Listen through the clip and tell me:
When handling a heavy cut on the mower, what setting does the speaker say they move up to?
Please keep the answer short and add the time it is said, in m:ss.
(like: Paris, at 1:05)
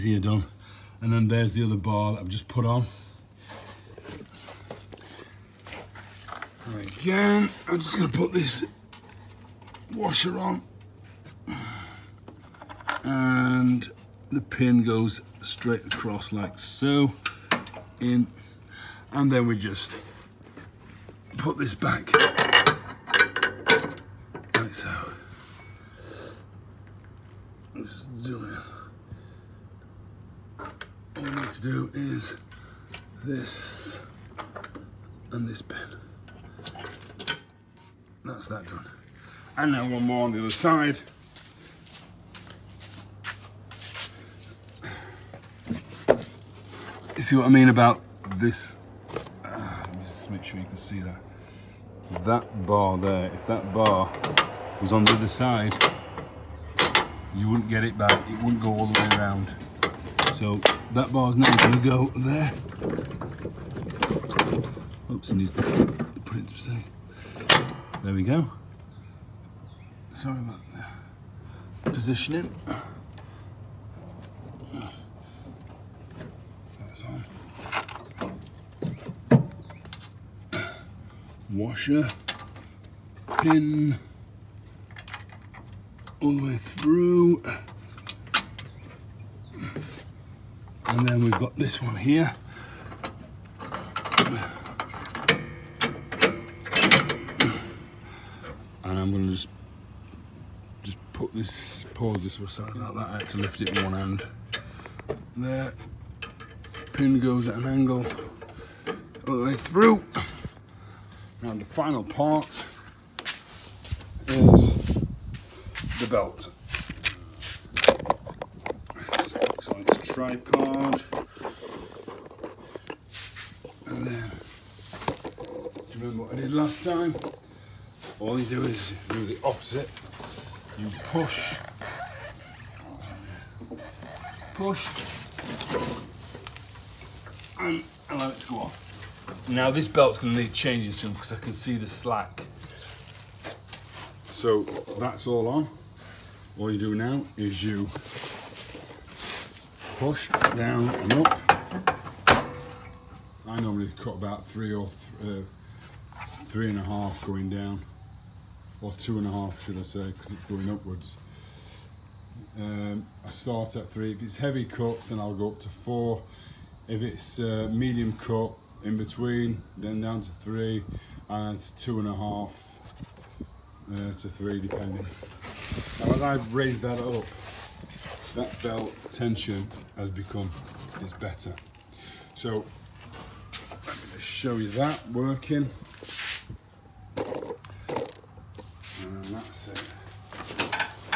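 4, at 2:45.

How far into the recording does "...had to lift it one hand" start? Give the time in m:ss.
1:43.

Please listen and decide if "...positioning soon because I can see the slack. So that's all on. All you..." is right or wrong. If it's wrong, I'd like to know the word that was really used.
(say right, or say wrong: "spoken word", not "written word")
wrong: "changing", not "positioning".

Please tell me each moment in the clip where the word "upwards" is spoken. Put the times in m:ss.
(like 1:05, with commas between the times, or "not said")
2:40.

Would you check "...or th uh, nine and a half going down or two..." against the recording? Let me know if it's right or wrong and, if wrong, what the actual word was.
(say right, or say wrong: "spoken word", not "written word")
wrong: "three", not "nine".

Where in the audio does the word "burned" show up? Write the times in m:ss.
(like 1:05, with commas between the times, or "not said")
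not said.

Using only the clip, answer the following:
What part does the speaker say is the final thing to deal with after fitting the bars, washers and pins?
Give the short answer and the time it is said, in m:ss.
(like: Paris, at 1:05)
The belt, at 1:55.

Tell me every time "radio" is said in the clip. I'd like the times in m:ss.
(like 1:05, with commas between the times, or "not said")
not said.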